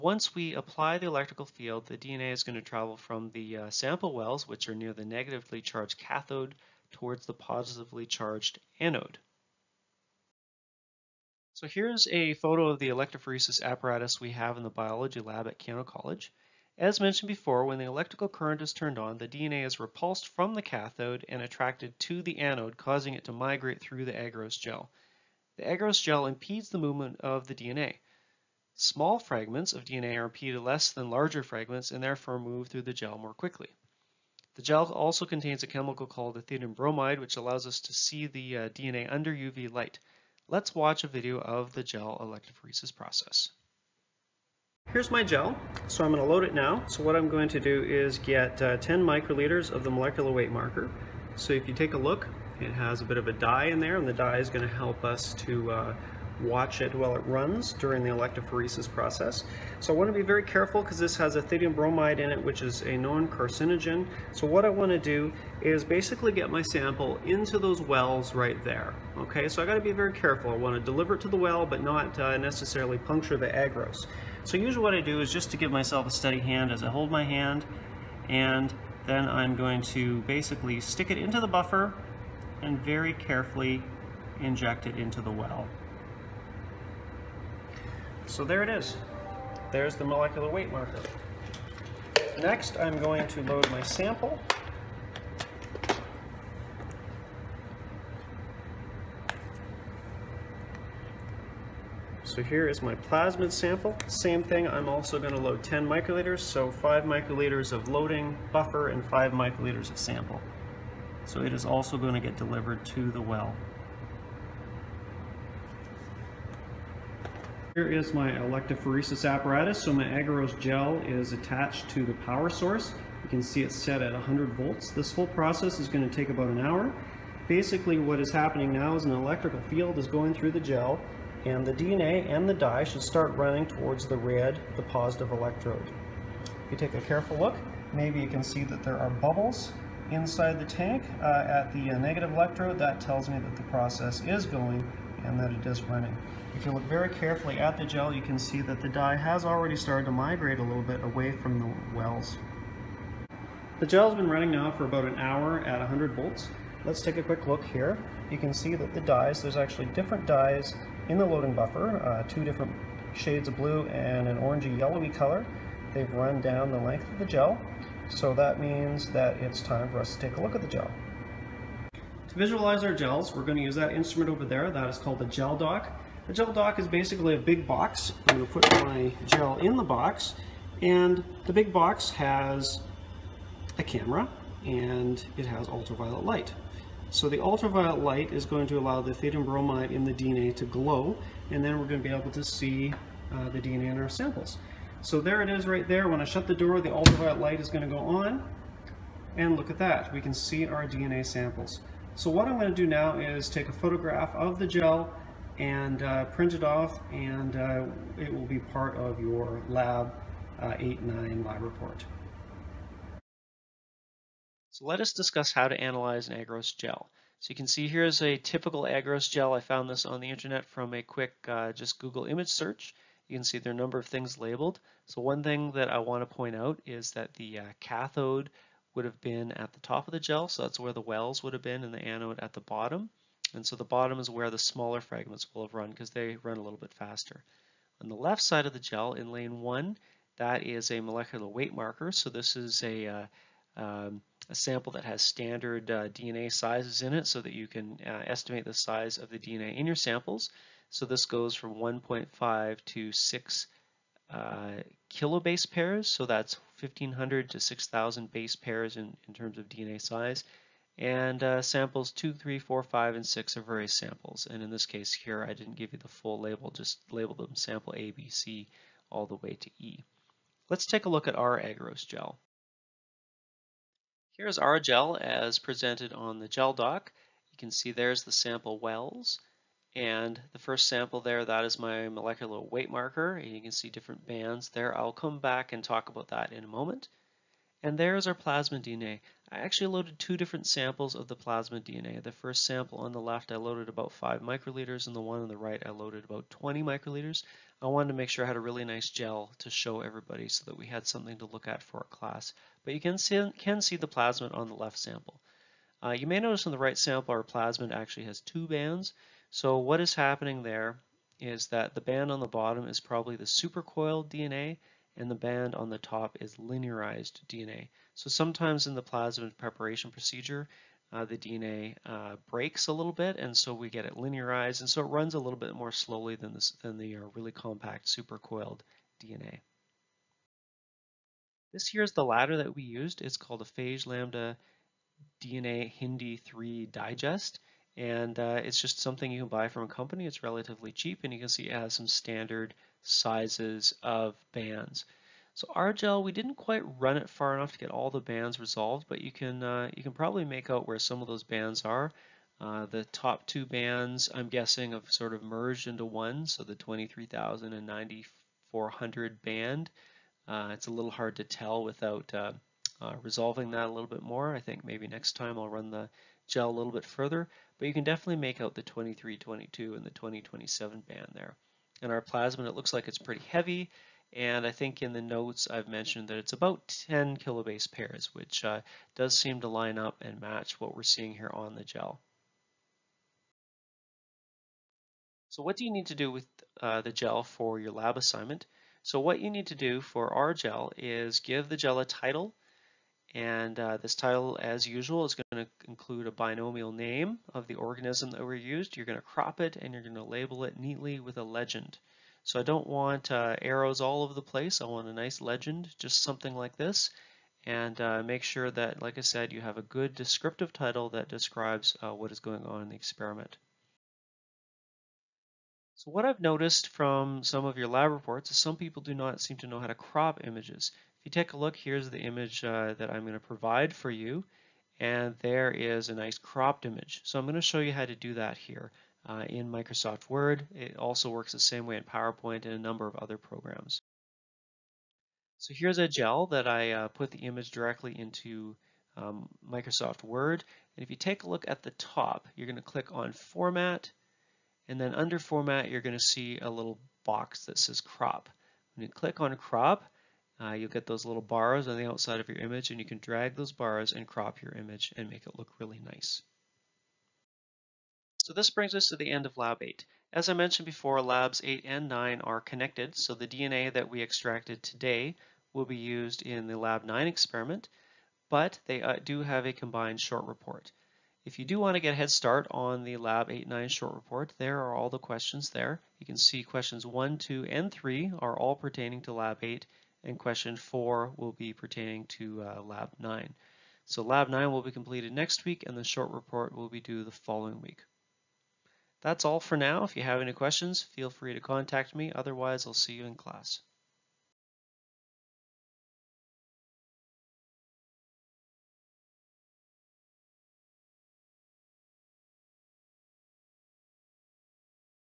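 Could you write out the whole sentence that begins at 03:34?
So let us discuss how to analyze an agarose gel.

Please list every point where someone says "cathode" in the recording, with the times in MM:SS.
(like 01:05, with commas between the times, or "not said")
00:05, 00:20, 03:47.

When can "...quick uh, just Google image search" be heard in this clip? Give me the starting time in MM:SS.
03:41.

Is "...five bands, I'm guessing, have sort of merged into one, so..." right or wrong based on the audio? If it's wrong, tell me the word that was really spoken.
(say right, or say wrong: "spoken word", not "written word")
wrong: "two", not "five".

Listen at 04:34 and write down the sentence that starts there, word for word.
Here's our gel as presented on the gel doc.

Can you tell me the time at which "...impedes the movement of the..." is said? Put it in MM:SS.
00:26.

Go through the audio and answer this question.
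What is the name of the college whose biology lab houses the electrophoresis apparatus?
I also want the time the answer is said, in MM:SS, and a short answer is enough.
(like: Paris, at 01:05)
Keyano College, at 00:15.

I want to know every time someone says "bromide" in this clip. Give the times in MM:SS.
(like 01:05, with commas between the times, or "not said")
00:36, 01:01, 03:09.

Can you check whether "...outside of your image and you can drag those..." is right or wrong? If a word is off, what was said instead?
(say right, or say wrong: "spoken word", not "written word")
right.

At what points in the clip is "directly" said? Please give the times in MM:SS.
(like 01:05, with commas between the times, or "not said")
07:17.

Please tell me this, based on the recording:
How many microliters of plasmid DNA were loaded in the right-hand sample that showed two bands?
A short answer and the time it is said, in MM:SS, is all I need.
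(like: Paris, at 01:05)
20, at 04:56.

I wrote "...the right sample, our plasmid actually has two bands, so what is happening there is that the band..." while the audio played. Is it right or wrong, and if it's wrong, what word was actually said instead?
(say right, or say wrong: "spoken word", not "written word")
right.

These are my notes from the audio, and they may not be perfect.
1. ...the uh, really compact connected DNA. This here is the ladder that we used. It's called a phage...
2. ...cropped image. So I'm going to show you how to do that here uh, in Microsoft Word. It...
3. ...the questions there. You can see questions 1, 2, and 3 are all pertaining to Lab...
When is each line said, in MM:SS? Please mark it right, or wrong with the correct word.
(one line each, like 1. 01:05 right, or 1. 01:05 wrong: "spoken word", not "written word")
1. 05:26 wrong: "supercoiled", not "connected"
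2. 07:06 right
3. 07:55 right.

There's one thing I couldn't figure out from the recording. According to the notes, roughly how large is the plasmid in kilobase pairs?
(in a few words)
10.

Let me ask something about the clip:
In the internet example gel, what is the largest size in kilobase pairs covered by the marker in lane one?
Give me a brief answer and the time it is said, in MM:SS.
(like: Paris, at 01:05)
6, at 04:13.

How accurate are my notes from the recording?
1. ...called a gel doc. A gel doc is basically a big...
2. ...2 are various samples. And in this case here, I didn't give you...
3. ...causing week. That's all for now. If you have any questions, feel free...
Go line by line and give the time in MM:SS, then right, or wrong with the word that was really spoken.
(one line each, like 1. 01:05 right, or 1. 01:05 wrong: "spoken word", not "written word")
1. 02:54 right
2. 04:23 wrong: "6", not "2"
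3. 08:07 wrong: "following", not "causing".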